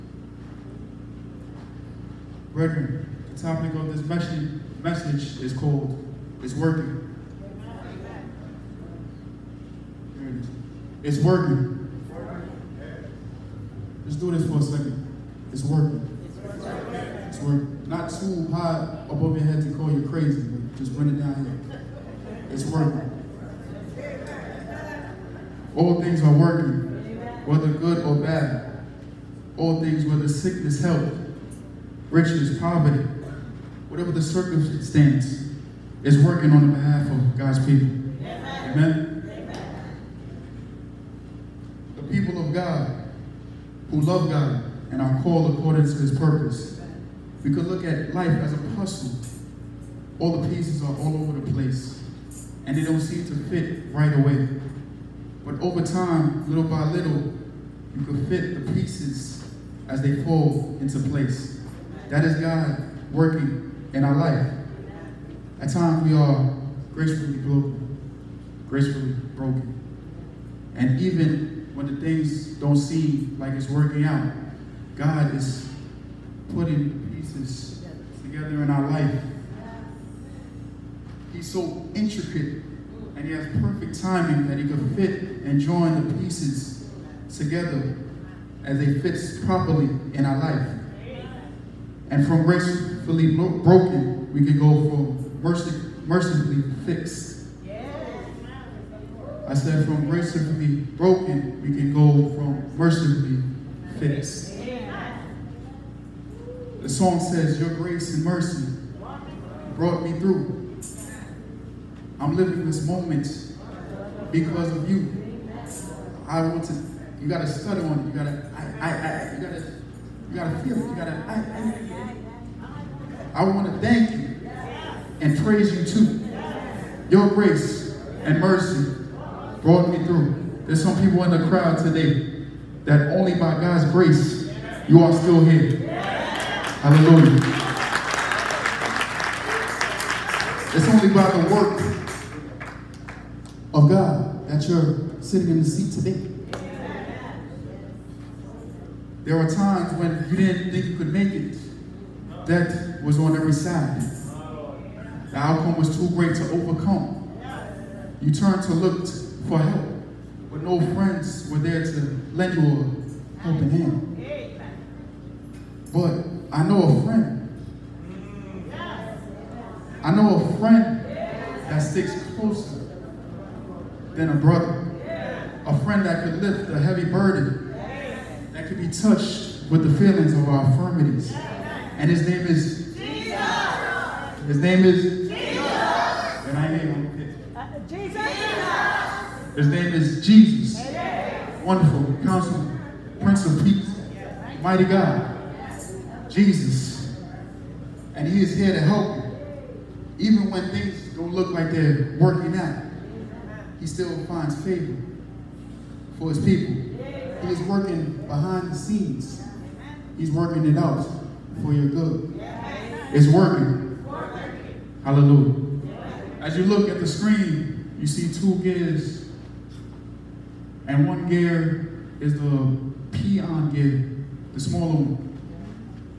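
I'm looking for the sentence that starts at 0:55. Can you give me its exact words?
But over time, little by little, you can fit the pieces as they fall into place.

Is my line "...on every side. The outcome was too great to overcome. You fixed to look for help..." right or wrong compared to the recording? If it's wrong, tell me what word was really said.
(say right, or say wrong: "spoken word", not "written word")
wrong: "turned", not "fixed".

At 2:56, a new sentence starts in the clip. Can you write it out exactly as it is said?
lift a heavy burden, that can be touched with the feelings of our infirmities.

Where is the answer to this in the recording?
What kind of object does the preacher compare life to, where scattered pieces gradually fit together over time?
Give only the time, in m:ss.
0:48.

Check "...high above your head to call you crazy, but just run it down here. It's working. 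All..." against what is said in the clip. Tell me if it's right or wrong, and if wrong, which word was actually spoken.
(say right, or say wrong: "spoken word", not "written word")
right.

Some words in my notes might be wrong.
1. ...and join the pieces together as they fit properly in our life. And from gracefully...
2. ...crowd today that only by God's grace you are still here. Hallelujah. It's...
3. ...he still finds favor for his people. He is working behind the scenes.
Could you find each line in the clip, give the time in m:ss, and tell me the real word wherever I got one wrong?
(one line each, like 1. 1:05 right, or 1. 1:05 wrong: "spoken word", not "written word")
1. 1:25 right
2. 2:11 right
3. 3:23 right.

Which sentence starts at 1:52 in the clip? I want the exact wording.
I'm living this moment because of you.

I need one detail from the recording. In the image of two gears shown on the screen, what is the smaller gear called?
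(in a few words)
Pinion gear.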